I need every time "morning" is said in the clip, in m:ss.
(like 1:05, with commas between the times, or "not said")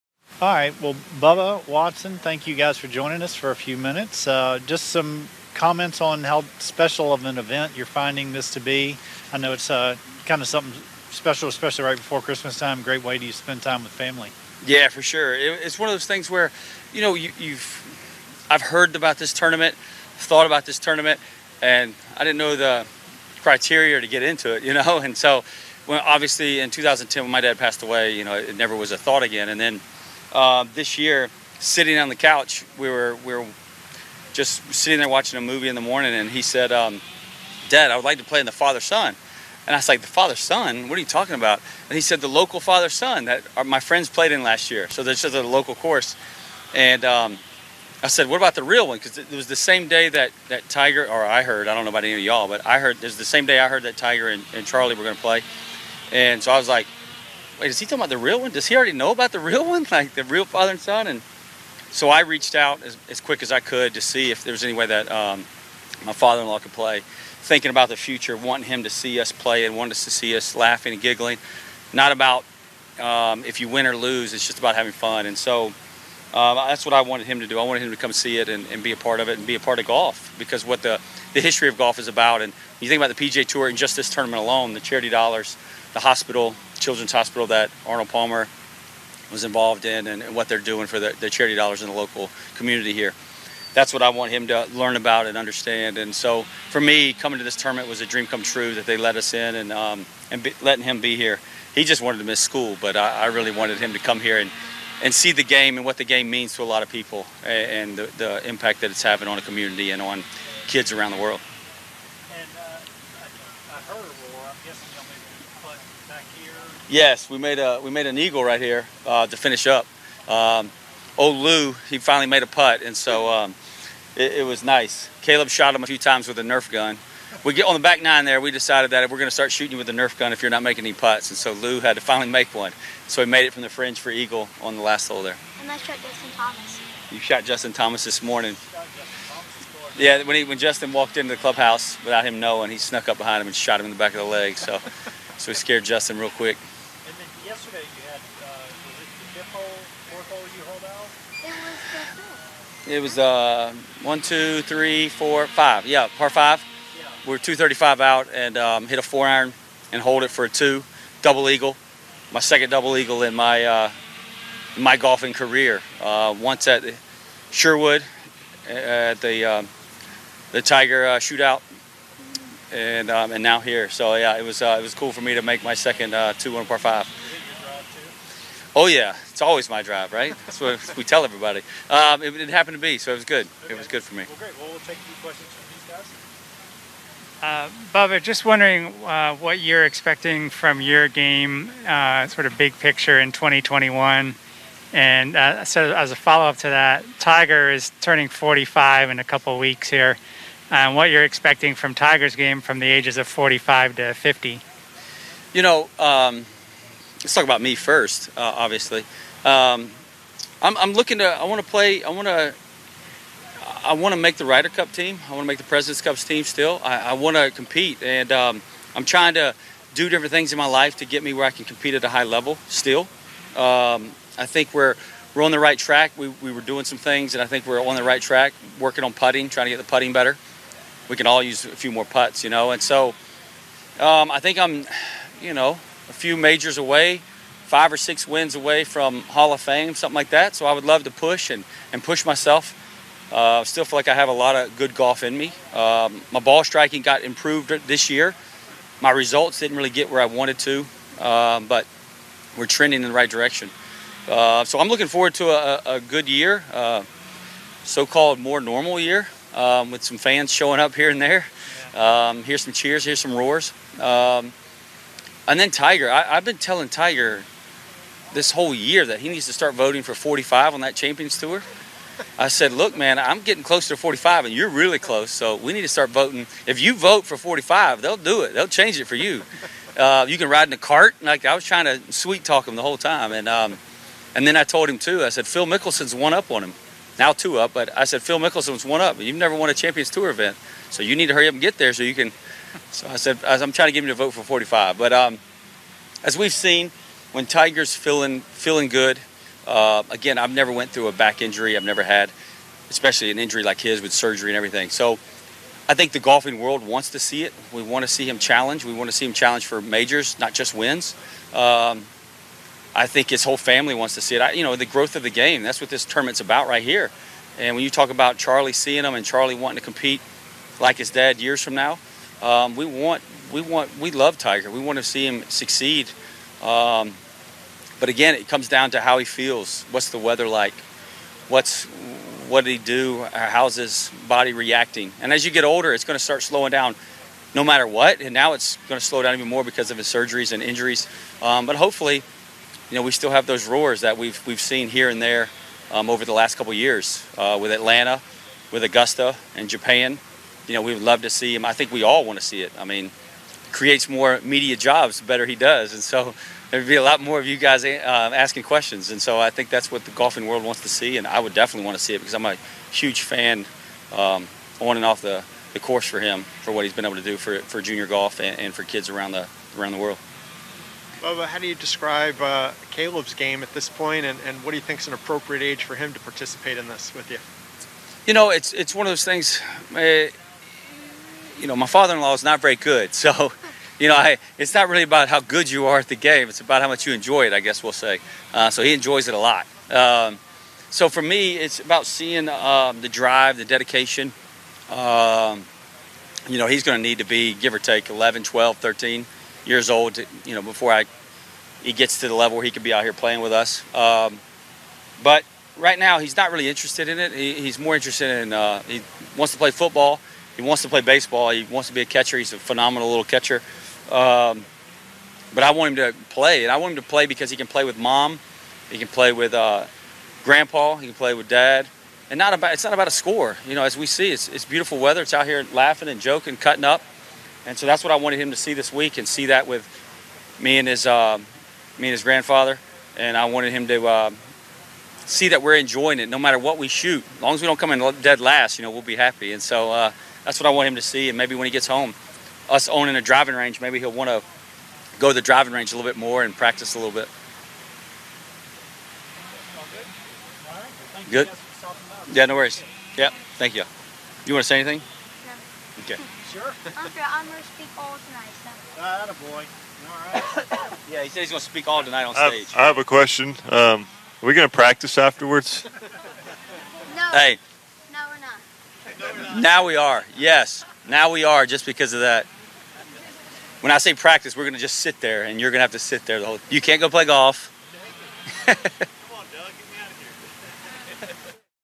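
0:35, 2:18.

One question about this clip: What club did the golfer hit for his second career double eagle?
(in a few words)
4 iron.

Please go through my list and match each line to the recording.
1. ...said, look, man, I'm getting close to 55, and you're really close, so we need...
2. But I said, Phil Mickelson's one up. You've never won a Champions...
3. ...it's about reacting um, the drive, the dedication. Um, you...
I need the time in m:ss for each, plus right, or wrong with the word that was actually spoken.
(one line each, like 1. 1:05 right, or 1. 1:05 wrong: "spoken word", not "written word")
1. 4:32 wrong: "45", not "55"
2. 4:47 right
3. 6:31 wrong: "seeing", not "reacting".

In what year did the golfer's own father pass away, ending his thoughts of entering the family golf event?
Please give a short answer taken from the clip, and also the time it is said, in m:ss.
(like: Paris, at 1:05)
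2010, at 0:26.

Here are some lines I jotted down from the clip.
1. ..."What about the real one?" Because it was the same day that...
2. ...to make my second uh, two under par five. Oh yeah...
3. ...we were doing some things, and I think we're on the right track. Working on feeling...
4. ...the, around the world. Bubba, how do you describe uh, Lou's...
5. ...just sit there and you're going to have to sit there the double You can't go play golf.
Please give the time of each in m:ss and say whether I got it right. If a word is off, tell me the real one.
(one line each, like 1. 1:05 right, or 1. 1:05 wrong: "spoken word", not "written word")
1. 0:48 right
2. 2:55 right
3. 3:46 wrong: "putting", not "feeling"
4. 6:09 wrong: "Caleb", not "Lou"
5. 7:54 wrong: "whole", not "double".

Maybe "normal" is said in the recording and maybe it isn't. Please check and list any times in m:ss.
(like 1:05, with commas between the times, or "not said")
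4:18.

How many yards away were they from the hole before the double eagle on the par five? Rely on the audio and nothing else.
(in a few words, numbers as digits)
235.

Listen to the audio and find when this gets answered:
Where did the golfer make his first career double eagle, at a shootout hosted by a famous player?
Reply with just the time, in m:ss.
2:47.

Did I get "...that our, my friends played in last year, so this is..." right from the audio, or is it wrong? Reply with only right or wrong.
right.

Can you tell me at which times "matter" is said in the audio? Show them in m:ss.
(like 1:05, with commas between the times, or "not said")
5:37, 7:16.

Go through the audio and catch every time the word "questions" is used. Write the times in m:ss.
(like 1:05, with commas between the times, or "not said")
3:05, 5:58, 7:43.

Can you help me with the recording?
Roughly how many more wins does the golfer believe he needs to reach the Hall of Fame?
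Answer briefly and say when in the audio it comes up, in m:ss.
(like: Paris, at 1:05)
5 or 6, at 3:57.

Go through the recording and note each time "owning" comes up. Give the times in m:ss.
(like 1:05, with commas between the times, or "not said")
7:22.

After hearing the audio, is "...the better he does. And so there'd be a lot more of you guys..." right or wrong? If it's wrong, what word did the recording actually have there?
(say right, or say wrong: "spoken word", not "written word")
right.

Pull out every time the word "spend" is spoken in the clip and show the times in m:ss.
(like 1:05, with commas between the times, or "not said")
0:13.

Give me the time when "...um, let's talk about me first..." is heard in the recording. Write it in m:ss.
3:25.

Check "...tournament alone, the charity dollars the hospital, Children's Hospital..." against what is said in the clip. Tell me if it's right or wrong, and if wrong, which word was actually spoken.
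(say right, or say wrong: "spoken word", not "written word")
right.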